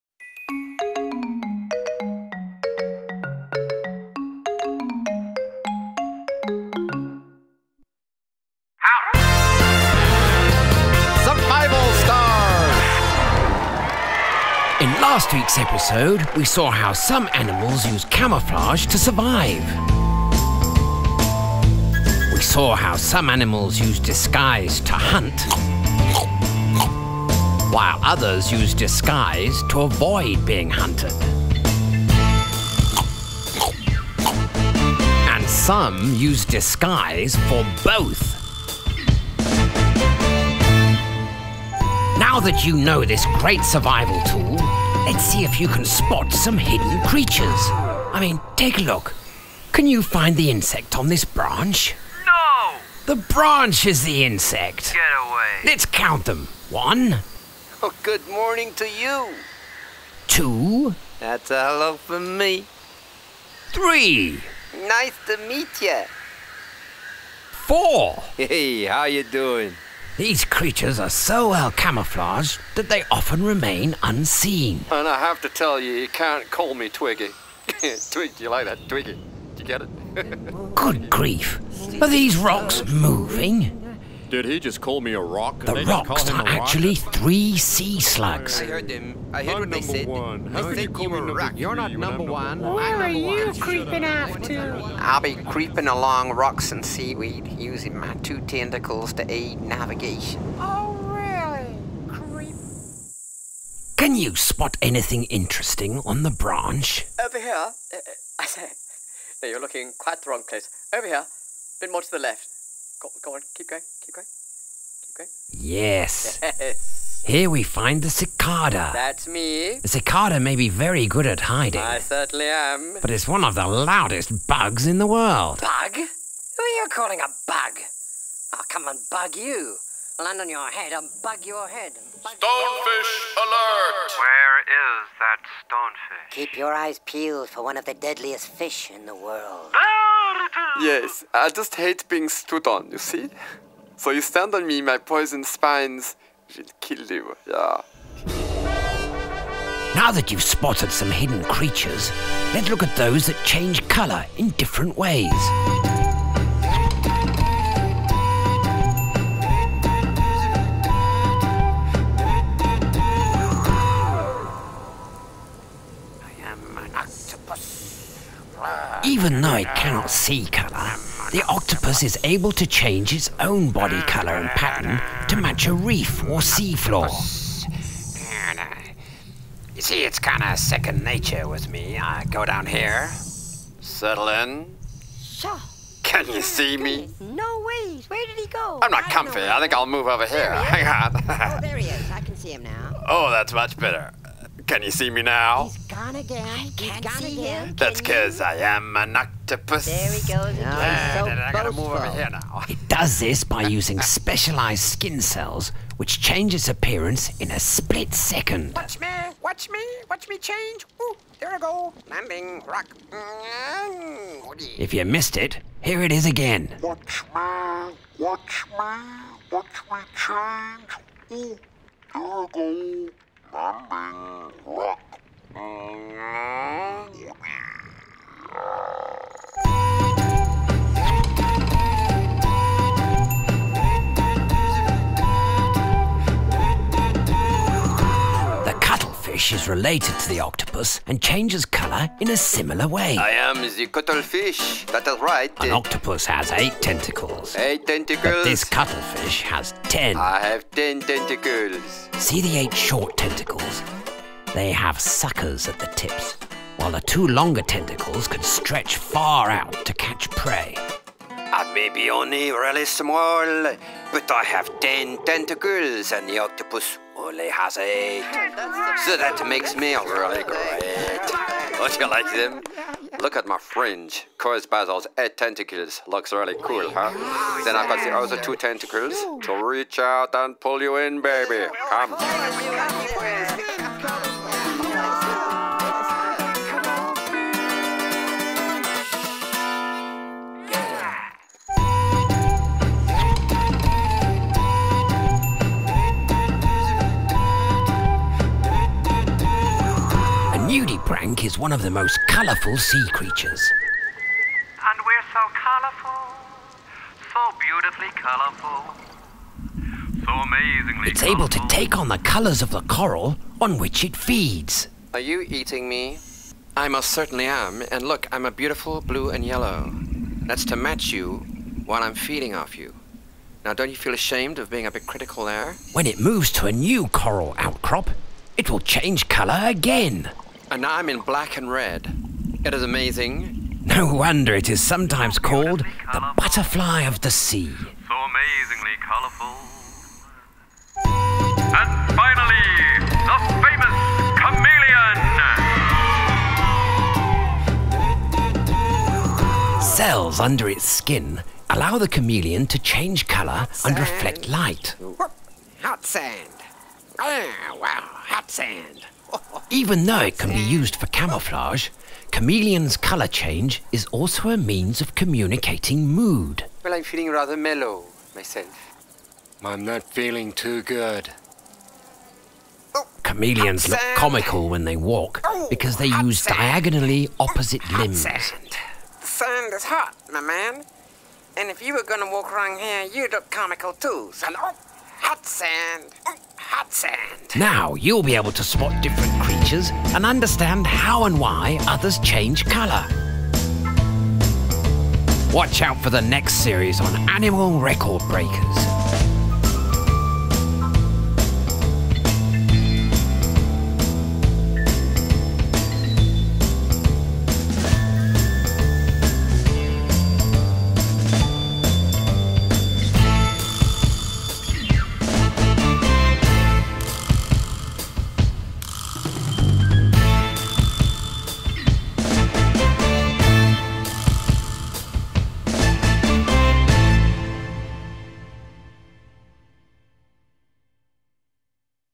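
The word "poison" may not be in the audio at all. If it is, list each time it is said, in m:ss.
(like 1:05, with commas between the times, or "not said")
2:24.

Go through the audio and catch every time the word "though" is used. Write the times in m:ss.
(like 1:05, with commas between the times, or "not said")
2:49, 6:00.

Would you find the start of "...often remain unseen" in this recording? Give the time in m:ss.
1:13.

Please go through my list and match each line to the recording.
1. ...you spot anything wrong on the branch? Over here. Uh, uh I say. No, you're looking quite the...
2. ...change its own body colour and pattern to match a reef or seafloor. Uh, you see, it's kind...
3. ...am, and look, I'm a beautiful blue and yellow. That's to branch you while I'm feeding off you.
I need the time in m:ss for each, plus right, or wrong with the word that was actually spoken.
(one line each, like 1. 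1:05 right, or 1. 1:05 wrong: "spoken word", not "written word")
1. 1:44 wrong: "interesting", not "wrong"
2. 2:52 right
3. 5:17 wrong: "match", not "branch".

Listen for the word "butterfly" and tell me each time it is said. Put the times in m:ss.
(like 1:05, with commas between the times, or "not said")
5:36.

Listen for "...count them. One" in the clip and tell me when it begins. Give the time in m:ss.
0:55.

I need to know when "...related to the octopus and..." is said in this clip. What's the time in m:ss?
3:59.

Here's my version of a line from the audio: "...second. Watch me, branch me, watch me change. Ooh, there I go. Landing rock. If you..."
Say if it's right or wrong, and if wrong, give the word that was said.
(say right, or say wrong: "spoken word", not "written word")
wrong: "watch", not "branch".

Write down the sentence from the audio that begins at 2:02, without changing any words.
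but it's one of the loudest bugs in the world.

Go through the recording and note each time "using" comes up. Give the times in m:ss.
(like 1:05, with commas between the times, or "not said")
1:37, 3:23.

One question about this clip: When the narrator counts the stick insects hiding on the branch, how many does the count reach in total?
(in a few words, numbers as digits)
4.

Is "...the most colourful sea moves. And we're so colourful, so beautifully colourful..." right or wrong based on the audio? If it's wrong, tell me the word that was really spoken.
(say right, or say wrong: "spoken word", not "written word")
wrong: "creatures", not "moves".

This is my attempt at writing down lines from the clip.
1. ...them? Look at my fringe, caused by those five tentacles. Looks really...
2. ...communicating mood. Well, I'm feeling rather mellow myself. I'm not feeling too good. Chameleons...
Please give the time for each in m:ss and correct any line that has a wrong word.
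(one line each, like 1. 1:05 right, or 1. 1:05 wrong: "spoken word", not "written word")
1. 4:32 wrong: "eight", not "five"
2. 6:05 right.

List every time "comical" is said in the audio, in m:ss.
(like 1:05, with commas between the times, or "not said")
6:14, 6:23.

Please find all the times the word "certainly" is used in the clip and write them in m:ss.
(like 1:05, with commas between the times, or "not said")
2:01, 5:17.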